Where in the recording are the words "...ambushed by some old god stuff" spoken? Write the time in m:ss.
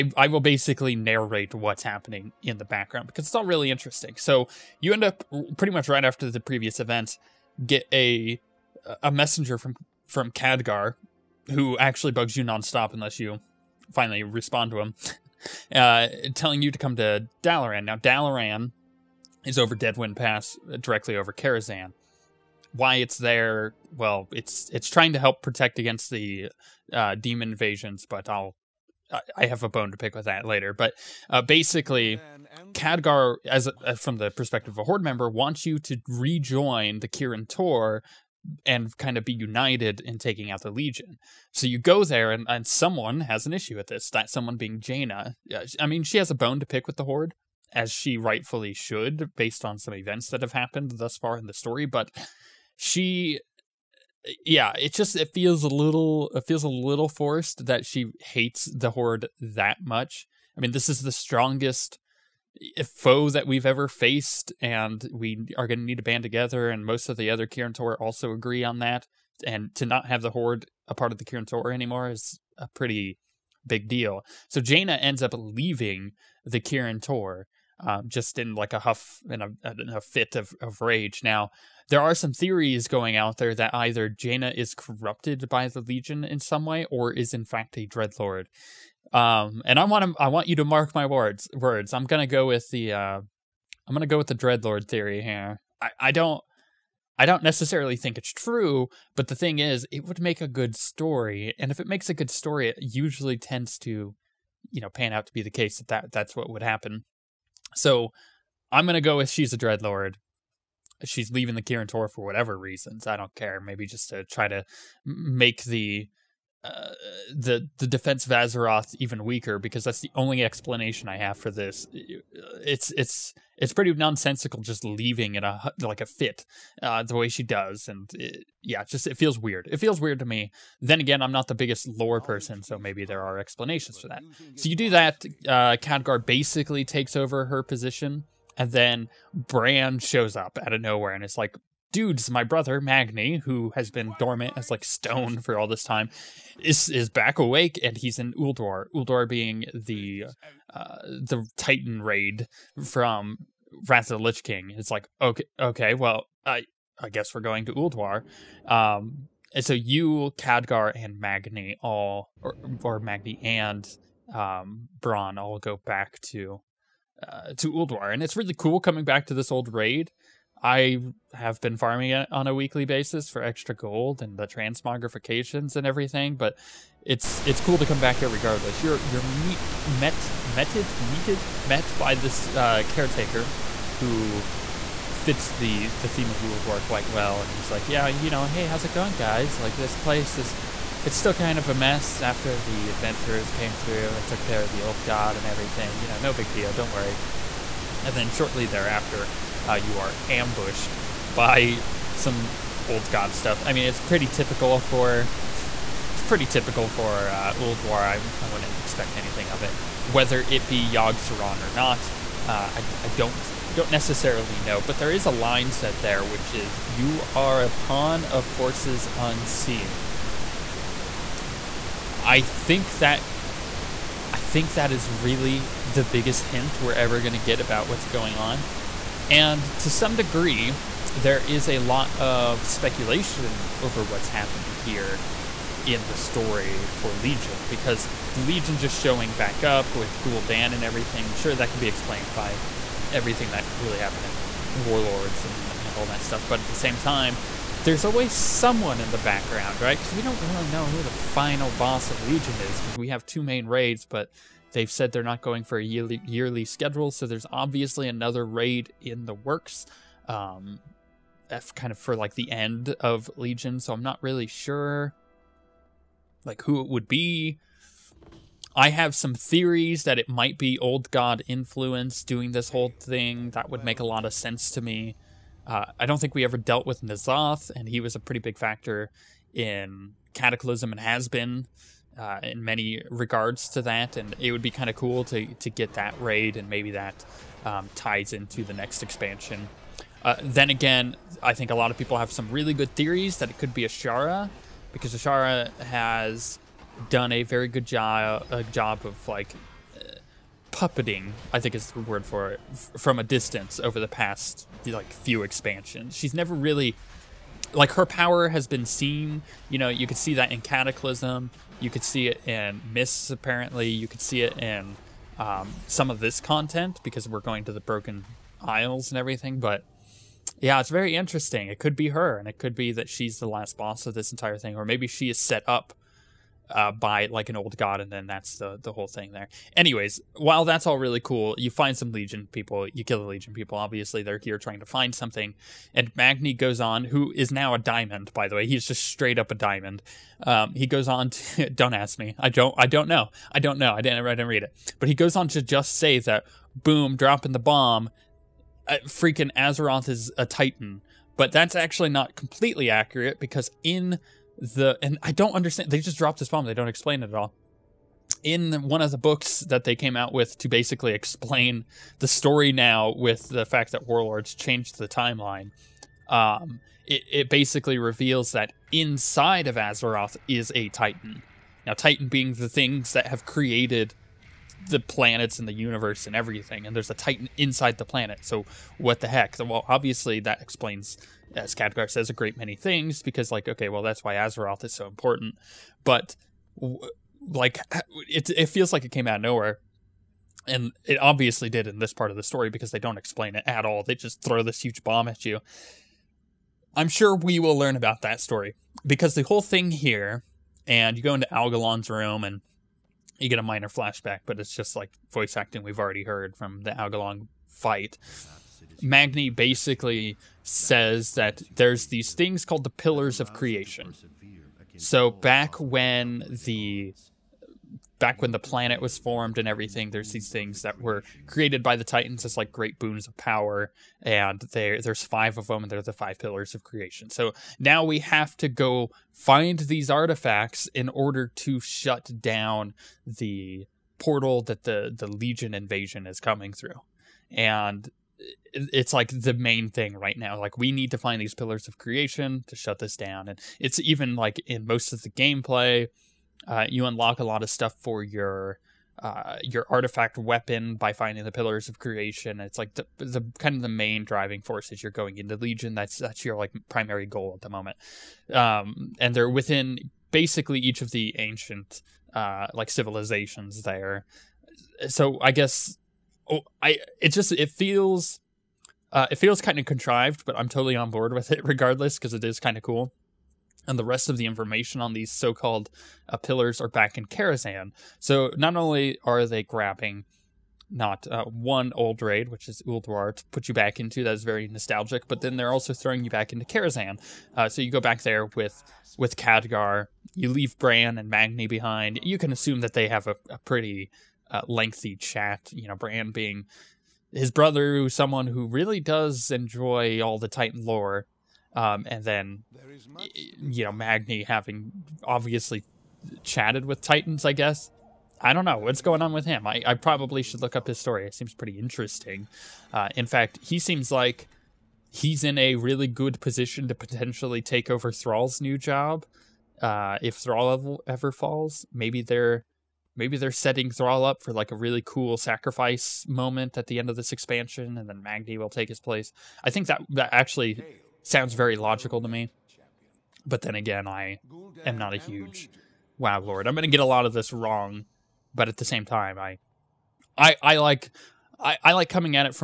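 3:20.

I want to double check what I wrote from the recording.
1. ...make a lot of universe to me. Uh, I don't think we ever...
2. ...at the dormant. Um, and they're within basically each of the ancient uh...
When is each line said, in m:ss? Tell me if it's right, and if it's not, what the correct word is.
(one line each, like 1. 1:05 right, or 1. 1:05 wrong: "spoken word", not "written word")
1. 4:33 wrong: "sense", not "universe"
2. 7:37 wrong: "moment", not "dormant".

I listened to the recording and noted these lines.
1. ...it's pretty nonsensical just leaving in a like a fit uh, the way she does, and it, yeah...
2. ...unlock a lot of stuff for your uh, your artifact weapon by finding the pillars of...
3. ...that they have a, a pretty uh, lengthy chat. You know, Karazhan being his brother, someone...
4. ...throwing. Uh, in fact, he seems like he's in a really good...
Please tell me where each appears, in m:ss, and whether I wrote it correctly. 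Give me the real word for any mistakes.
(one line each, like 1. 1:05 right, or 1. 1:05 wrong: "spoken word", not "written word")
1. 2:03 right
2. 7:27 right
3. 8:12 wrong: "Bran", not "Karazhan"
4. 8:31 wrong: "interesting", not "throwing".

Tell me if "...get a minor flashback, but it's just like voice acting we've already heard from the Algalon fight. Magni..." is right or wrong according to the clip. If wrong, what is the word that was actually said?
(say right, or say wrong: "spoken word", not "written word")
right.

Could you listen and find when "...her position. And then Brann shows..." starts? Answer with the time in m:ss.
2:17.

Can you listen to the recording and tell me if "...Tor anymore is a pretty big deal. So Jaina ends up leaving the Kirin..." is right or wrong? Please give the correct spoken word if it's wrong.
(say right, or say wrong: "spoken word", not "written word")
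right.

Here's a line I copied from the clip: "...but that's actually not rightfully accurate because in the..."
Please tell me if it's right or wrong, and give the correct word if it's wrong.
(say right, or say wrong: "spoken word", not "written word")
wrong: "completely", not "rightfully".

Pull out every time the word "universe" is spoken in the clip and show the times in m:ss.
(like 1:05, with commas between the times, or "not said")
6:15.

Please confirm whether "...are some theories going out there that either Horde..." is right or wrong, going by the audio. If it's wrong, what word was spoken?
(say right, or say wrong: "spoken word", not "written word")
wrong: "Jaina", not "Horde".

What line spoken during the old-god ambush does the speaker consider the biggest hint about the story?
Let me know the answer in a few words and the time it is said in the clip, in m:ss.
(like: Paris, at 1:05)
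You are a pawn of forces unseen, at 3:36.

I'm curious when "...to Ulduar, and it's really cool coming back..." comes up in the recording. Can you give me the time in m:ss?
2:47.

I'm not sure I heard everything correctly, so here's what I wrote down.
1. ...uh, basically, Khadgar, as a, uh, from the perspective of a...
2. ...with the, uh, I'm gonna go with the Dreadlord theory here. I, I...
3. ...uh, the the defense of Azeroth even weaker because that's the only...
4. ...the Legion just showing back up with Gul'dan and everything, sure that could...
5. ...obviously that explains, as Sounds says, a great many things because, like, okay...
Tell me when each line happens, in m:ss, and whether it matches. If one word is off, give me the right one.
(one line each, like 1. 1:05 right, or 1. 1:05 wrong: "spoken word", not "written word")
1. 0:31 right
2. 1:32 right
3. 1:56 right
4. 3:58 right
5. 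6:19 wrong: "Khadgar", not "Sounds".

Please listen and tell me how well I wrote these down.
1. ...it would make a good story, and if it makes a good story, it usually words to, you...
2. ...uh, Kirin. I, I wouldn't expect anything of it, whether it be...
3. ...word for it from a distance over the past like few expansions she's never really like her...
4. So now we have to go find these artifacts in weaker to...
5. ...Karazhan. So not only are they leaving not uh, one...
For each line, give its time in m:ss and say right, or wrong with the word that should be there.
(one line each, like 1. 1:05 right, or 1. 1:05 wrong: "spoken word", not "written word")
1. 1:39 wrong: "tends", not "words"
2. 3:27 wrong: "Ulduar", not "Kirin"
3. 5:02 right
4. 7:07 wrong: "order", not "weaker"
5. 7:57 wrong: "grabbing", not "leaving".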